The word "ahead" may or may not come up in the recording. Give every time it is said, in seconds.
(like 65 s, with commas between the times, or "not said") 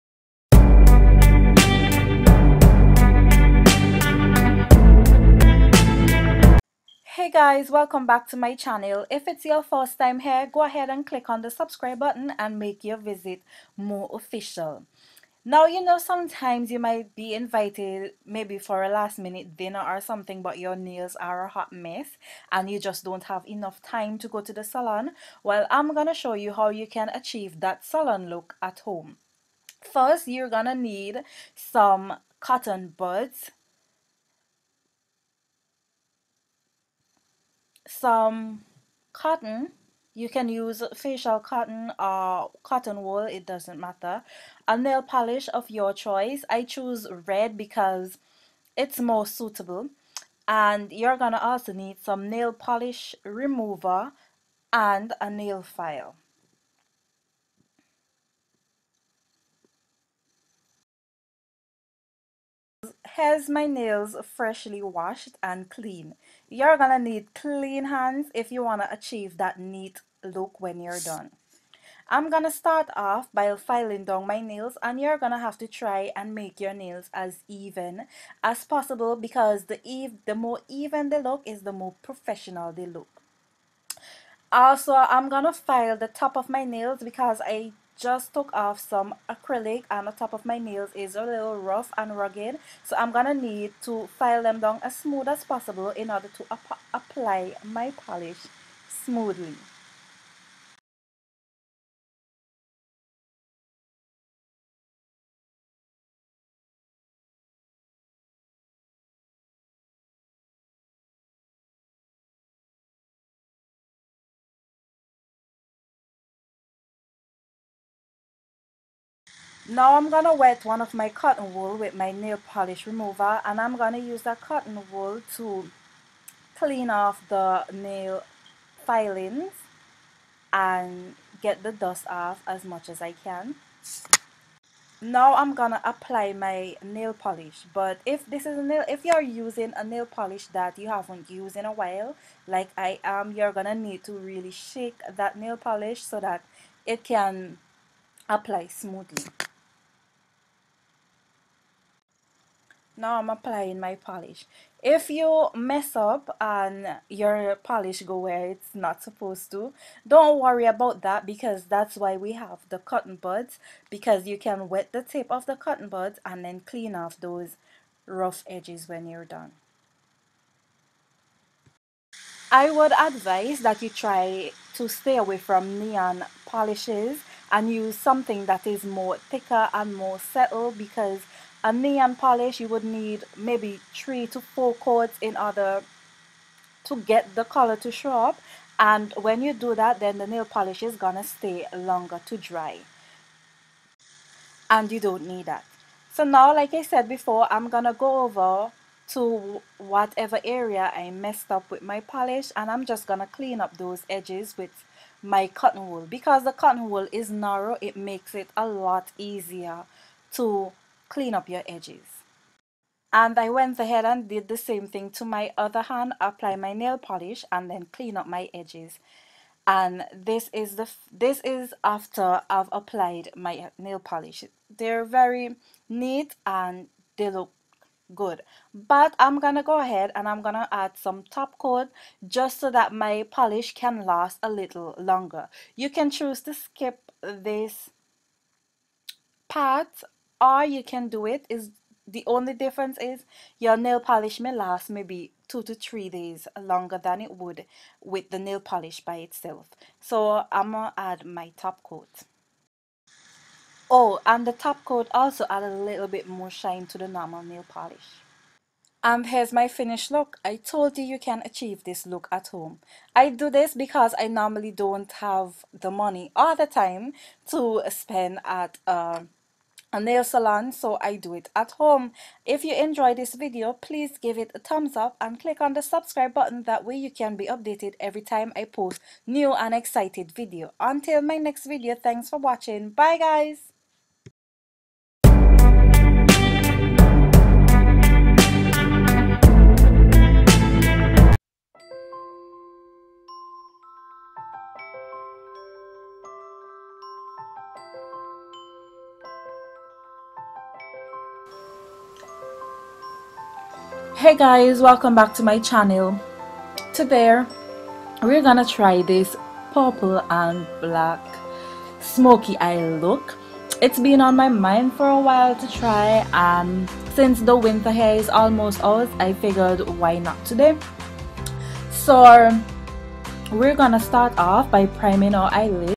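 10 s, 213 s, 229 s.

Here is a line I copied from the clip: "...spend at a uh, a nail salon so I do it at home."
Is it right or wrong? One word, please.
right.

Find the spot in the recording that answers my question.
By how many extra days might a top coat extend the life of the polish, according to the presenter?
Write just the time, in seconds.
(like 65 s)
245 s.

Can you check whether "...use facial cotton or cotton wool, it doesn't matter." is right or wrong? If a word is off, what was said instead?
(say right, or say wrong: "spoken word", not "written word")
right.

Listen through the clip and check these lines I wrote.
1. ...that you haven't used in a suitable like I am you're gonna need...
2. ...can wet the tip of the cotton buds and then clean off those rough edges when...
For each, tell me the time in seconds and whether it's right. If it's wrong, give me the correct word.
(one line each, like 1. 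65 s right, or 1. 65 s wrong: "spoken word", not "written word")
1. 140 s wrong: "while", not "suitable"
2. 164 s right.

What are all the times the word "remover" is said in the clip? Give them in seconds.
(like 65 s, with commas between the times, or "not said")
53 s, 122 s.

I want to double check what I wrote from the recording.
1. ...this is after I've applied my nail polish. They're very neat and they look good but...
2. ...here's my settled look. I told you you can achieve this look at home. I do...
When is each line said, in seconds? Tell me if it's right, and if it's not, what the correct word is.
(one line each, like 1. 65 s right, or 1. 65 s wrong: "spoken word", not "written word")
1. 221 s right
2. 259 s wrong: "finished", not "settled".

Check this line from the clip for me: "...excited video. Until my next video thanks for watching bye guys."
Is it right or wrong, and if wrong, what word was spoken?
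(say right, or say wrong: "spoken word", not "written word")
right.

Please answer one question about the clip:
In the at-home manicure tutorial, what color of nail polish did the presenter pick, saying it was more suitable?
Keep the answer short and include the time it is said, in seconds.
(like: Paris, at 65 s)
Red, at 47 s.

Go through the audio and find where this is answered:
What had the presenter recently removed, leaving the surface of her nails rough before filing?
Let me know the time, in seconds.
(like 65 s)
89 s.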